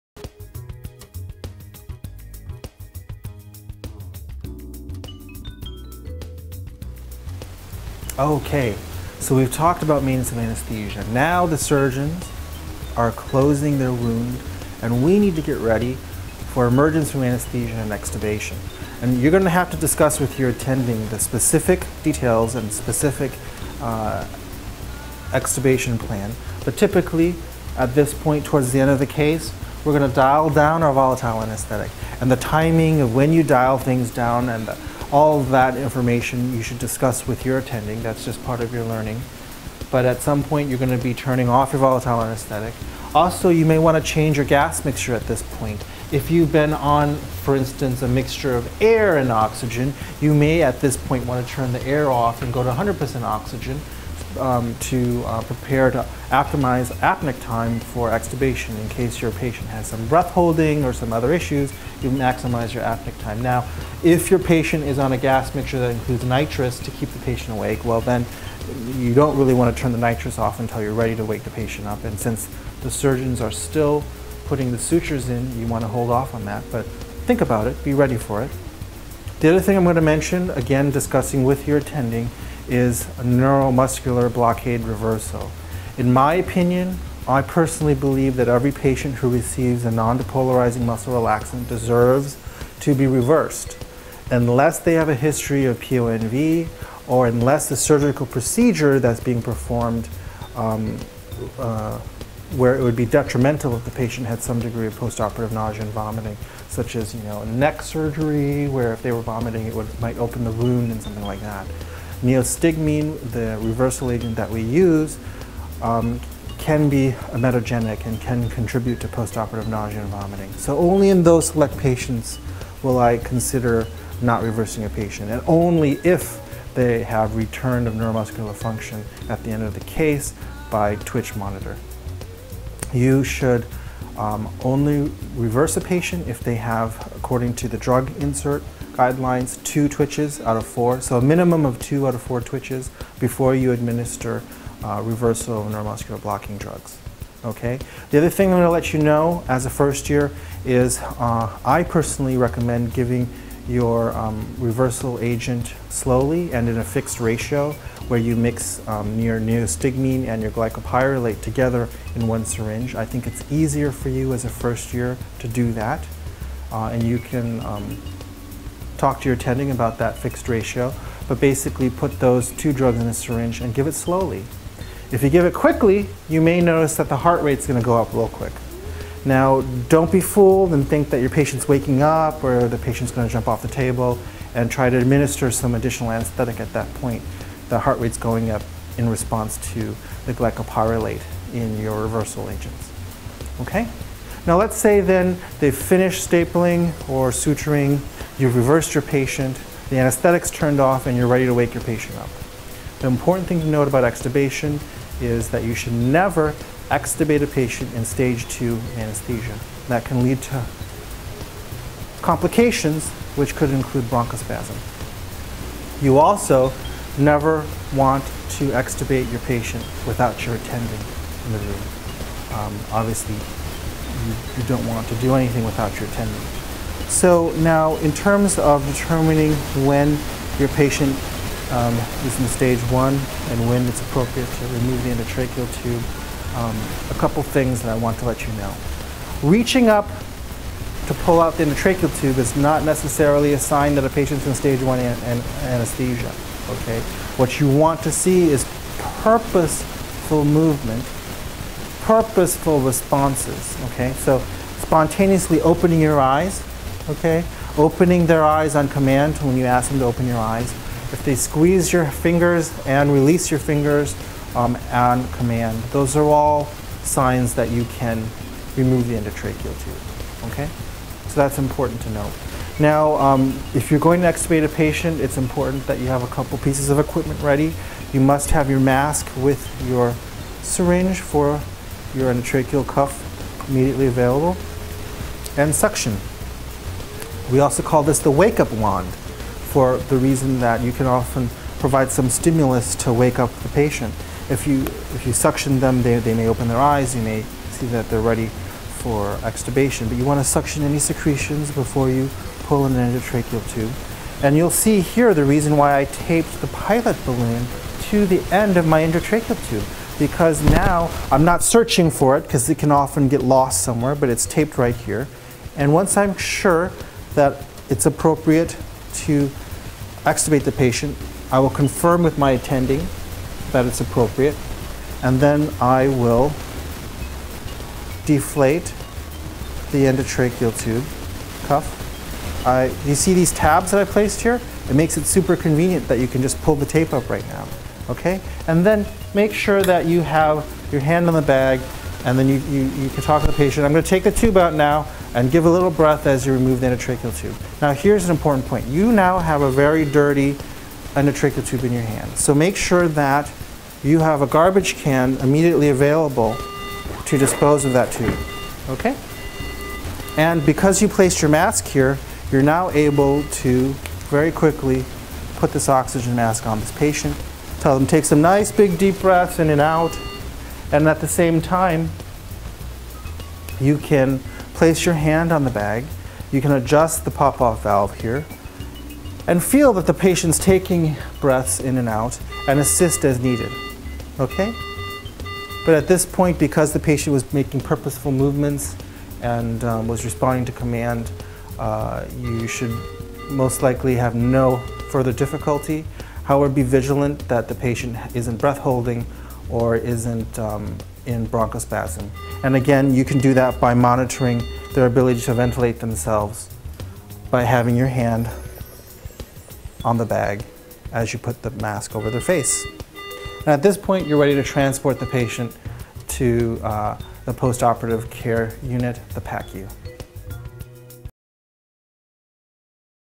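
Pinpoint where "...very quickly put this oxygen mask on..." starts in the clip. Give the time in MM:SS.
06:04.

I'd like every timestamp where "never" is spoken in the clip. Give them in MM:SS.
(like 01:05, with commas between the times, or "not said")
03:25, 03:37.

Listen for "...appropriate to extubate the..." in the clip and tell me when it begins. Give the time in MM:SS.
05:18.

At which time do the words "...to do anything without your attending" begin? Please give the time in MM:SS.
03:45.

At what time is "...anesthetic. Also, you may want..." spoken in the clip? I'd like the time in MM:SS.
00:42.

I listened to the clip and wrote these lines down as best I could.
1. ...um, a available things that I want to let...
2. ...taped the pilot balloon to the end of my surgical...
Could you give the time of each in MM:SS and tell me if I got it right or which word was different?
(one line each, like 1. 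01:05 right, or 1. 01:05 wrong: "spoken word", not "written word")
1. 03:56 wrong: "couple", not "available"
2. 05:06 wrong: "endotracheal", not "surgical".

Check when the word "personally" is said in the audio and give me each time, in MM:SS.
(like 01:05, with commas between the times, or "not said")
01:27, 02:31.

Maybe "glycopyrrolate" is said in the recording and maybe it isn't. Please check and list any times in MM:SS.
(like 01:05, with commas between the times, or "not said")
02:40, 03:10.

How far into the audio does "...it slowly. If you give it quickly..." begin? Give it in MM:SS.
02:53.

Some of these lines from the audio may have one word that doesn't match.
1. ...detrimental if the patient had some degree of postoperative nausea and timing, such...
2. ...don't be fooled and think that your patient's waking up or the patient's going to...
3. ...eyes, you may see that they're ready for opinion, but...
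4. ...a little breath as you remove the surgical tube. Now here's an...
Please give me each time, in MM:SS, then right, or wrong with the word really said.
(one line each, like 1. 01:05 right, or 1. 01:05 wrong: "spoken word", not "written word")
1. 01:43 wrong: "vomiting", not "timing"
2. 02:59 right
3. 04:56 wrong: "extubation", not "opinion"
4. 05:45 wrong: "endotracheal", not "surgical".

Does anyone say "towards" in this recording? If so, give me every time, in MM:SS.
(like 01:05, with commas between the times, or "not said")
00:28.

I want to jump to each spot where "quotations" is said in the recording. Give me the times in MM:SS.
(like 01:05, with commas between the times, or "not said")
not said.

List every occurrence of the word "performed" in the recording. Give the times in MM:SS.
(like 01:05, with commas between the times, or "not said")
01:39.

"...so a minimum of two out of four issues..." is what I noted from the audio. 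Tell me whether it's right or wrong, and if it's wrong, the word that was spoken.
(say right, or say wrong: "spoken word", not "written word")
wrong: "twitches", not "issues".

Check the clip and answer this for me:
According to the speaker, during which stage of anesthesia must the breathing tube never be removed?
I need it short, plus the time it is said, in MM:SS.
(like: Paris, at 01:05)
stage two, at 03:28.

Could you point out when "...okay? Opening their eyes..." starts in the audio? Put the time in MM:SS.
04:17.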